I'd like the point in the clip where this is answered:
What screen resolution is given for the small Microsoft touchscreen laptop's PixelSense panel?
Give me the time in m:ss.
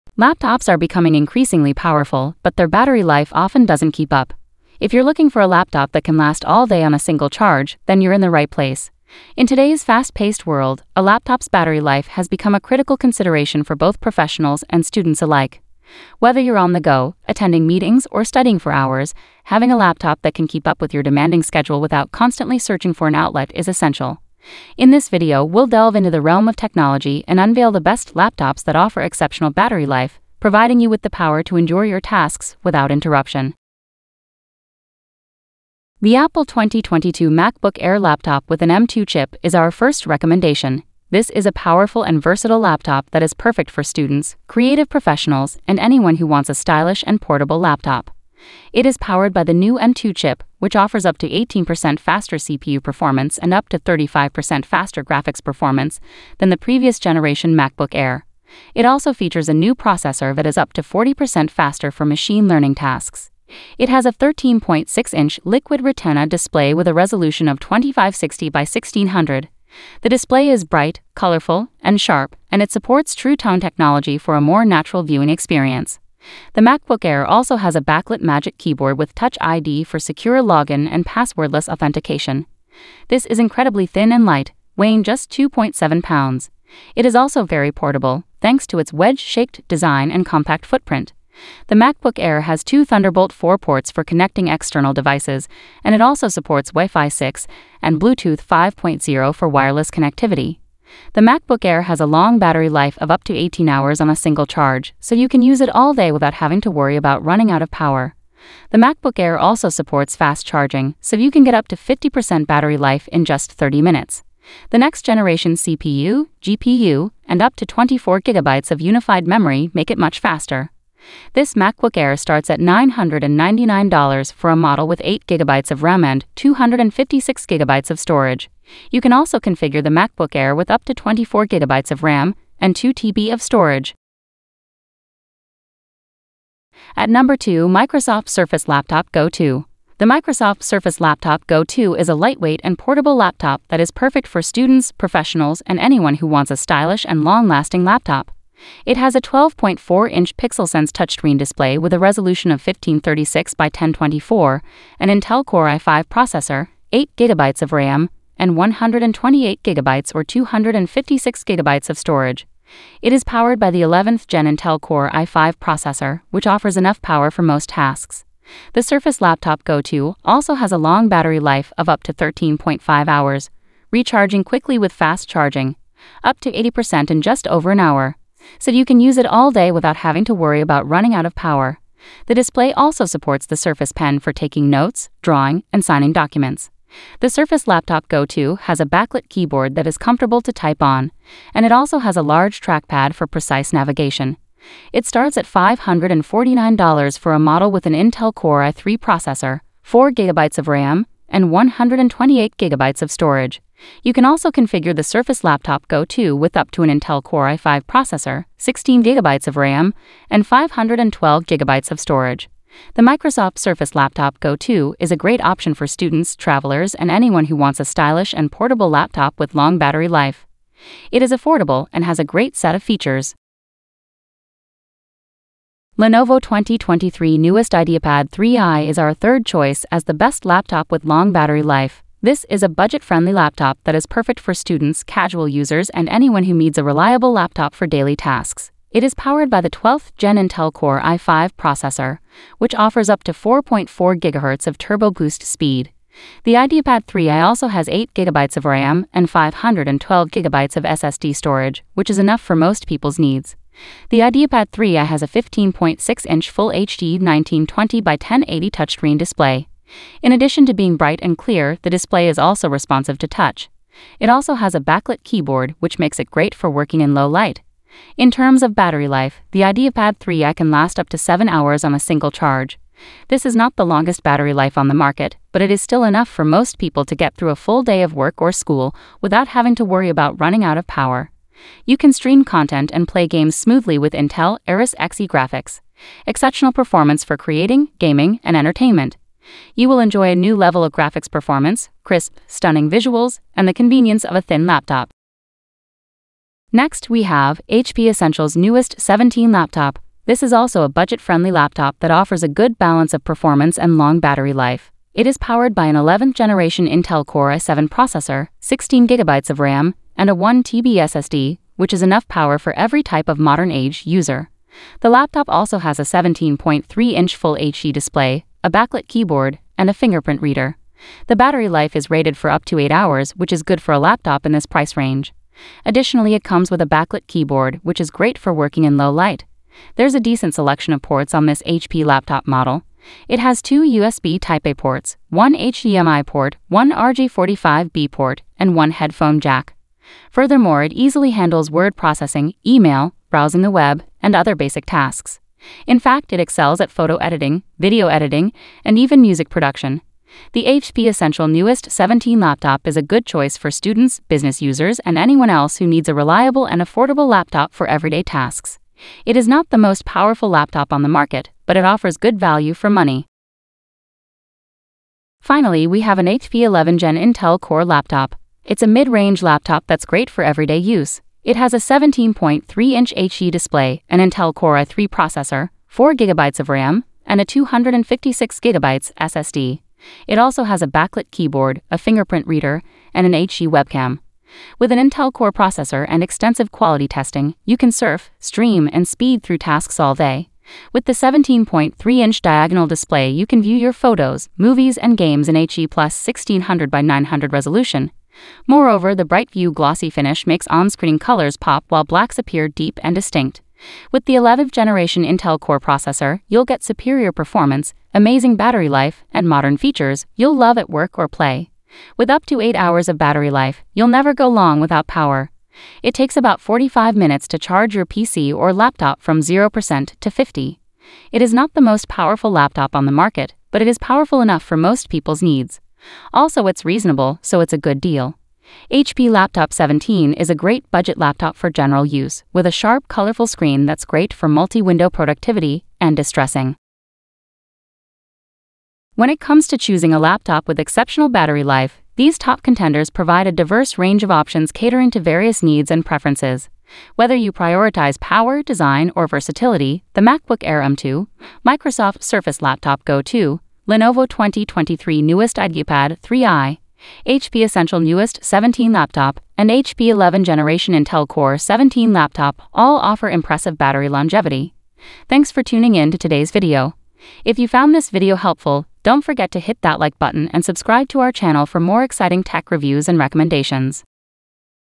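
2:32.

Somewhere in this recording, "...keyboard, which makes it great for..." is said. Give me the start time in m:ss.
4:25.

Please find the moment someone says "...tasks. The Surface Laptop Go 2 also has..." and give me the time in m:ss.
2:47.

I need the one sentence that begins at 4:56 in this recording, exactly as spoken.
Next, we have HP Essential's newest 17 laptop.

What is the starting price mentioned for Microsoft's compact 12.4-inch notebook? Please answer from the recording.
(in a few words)
$549.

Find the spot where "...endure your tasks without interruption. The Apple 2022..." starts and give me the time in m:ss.
0:31.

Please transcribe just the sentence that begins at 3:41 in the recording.
It is affordable and has a great set of features.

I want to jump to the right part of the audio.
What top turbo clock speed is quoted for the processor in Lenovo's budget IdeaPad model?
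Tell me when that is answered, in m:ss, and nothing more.
4:03.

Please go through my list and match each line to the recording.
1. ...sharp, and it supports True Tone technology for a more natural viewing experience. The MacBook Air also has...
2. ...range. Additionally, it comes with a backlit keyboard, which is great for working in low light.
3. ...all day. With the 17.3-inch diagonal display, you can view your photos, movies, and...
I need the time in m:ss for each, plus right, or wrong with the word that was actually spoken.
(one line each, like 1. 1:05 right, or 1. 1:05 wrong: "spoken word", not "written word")
1. 1:11 right
2. 5:24 right
3. 6:29 right.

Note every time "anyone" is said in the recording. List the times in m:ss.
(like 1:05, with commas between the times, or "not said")
0:45, 2:25, 3:37, 3:56, 5:55.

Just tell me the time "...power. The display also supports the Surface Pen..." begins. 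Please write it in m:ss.
3:01.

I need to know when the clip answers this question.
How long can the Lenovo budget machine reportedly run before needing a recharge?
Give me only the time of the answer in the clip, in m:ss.
4:31.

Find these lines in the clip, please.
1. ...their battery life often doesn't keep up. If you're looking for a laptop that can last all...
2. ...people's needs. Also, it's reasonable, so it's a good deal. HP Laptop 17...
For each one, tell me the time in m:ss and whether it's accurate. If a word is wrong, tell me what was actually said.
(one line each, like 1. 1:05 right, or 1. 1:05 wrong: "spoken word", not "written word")
1. 0:02 right
2. 7:05 right.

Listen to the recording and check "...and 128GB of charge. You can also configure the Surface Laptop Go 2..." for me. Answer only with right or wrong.
wrong.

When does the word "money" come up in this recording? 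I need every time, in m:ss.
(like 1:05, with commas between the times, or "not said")
6:02.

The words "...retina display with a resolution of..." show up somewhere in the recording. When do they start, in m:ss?
1:05.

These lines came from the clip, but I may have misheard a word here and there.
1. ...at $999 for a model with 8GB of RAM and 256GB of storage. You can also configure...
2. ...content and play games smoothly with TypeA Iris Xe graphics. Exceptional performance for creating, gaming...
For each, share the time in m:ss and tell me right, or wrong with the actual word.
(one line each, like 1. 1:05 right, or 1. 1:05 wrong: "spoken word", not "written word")
1. 2:02 right
2. 4:42 wrong: "Intel", not "TypeA".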